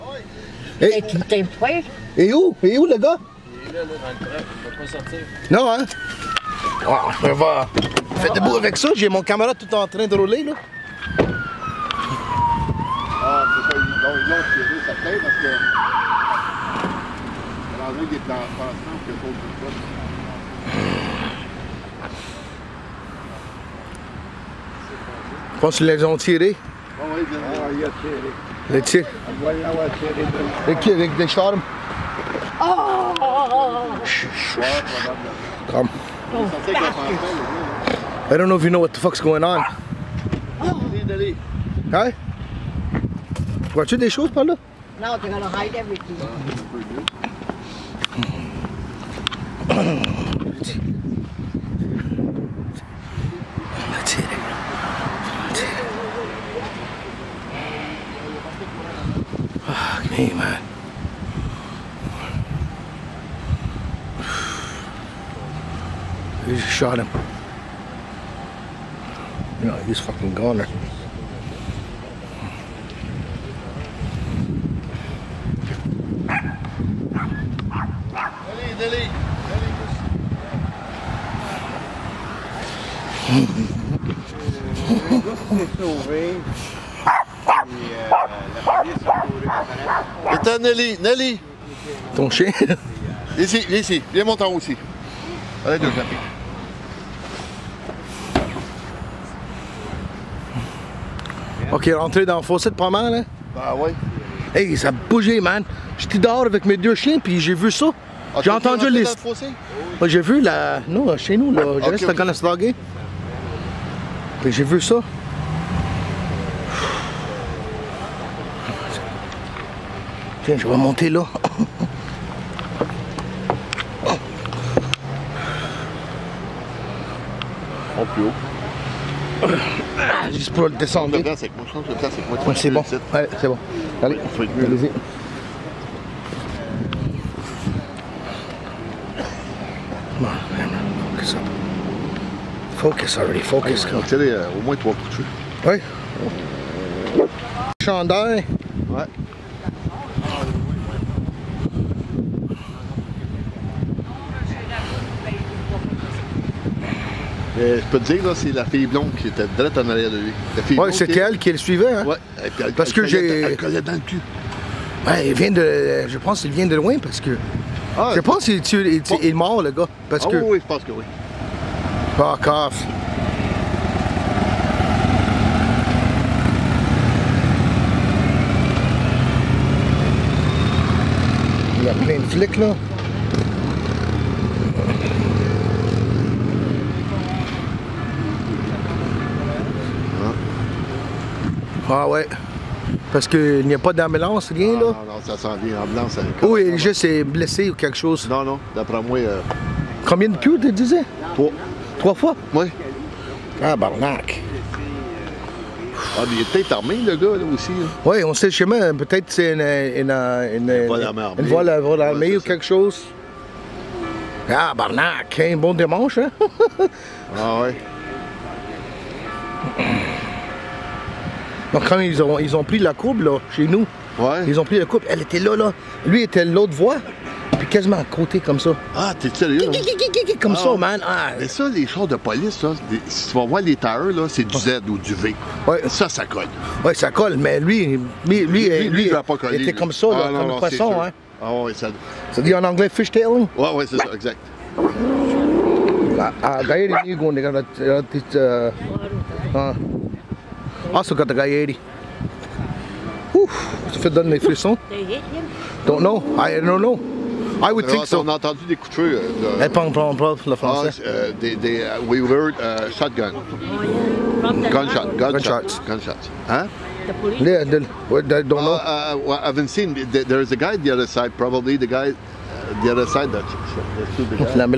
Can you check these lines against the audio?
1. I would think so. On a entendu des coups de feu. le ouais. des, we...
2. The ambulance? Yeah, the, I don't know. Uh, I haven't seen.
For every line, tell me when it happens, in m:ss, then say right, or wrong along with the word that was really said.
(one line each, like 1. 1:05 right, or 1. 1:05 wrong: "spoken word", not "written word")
1. 4:17 wrong: "français", not "ouais"
2. 4:27 wrong: "police", not "ambulance".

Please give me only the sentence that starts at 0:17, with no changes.
Alors là, il est en le passant que l'autre du Je pense qu'ils les ont tirés.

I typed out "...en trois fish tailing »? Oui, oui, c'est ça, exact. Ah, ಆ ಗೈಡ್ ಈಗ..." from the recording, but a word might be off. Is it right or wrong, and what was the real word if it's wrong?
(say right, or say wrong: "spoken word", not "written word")
wrong: "anglais", not "trois".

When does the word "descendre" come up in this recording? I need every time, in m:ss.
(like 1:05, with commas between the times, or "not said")
2:10.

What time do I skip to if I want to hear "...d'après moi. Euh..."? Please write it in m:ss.
3:18.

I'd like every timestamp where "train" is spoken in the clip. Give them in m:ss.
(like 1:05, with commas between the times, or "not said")
0:04, 0:09.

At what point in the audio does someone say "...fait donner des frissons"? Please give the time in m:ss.
4:13.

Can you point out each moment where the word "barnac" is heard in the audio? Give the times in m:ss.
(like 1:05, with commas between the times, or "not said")
3:23, 3:34.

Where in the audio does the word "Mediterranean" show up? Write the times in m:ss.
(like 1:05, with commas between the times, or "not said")
not said.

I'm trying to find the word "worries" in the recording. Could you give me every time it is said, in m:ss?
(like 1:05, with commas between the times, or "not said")
not said.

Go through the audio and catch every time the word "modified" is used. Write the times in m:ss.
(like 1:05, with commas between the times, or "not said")
not said.